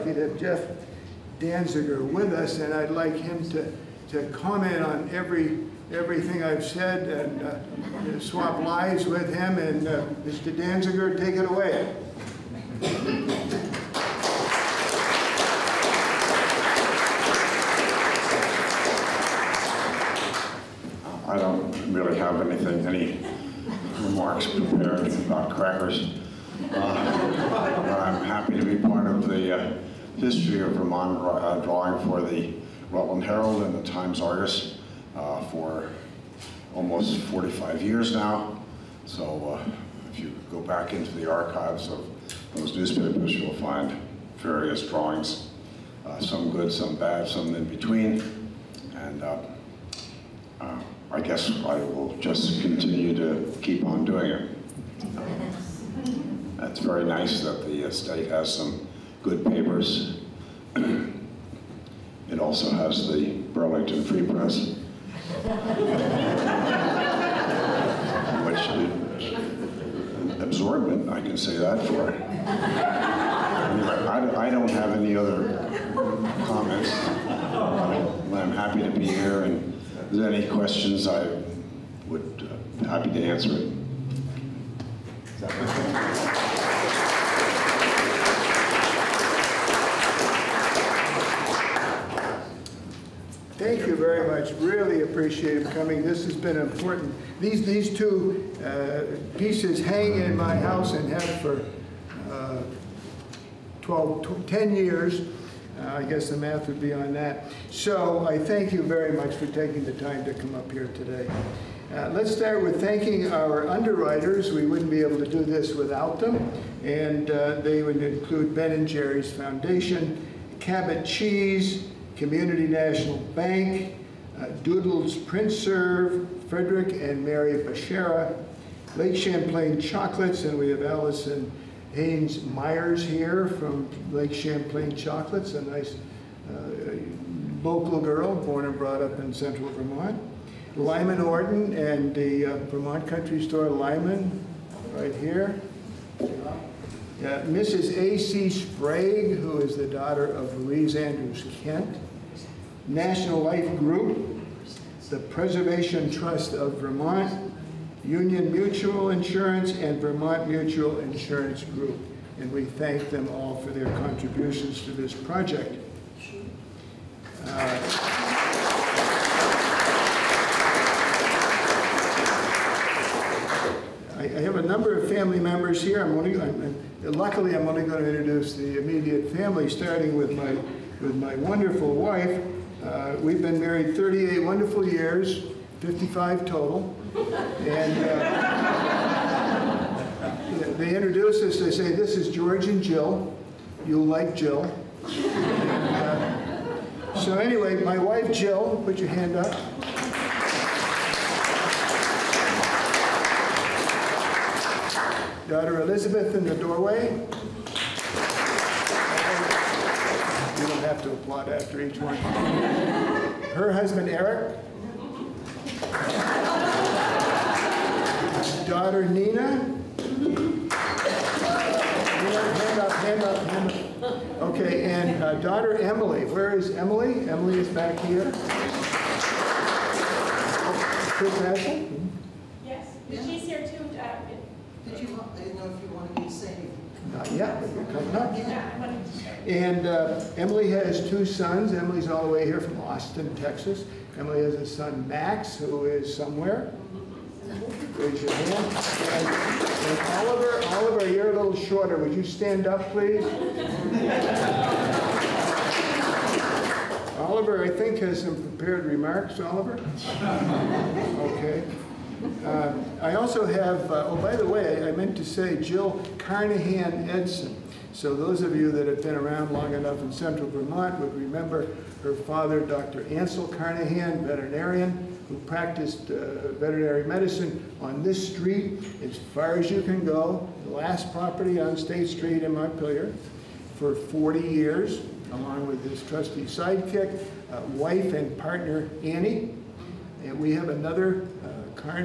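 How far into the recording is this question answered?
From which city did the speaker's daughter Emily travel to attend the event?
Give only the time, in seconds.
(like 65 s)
242 s.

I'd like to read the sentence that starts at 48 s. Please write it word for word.
And uh, I guess I will just continue to keep on doing it.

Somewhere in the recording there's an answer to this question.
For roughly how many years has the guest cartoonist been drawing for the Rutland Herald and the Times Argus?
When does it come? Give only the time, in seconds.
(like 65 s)
37 s.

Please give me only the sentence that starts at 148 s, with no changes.
Sprague, who is the daughter of Louise Andrews Kent.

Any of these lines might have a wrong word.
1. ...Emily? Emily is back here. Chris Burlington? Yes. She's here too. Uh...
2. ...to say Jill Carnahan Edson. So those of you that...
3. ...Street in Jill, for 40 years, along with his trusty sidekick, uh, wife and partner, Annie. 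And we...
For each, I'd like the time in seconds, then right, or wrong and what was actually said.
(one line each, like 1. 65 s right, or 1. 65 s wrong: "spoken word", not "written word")
1. 226 s wrong: "Ashley", not "Burlington"
2. 265 s right
3. 282 s wrong: "Montpelier", not "Jill".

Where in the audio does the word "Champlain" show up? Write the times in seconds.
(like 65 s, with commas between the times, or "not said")
129 s, 134 s.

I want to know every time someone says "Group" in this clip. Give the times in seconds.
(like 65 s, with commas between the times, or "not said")
153 s, 161 s.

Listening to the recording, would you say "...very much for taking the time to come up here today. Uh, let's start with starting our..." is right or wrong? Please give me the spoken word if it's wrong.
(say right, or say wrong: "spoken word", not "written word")
wrong: "thanking", not "starting".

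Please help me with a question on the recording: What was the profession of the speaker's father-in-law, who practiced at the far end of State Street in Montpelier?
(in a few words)
Veterinarian.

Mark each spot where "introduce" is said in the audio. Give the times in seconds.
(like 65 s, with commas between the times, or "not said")
178 s, 190 s.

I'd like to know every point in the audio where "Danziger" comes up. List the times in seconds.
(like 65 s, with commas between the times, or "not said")
1 s, 10 s.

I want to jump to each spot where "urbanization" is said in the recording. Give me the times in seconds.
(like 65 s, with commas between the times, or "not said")
not said.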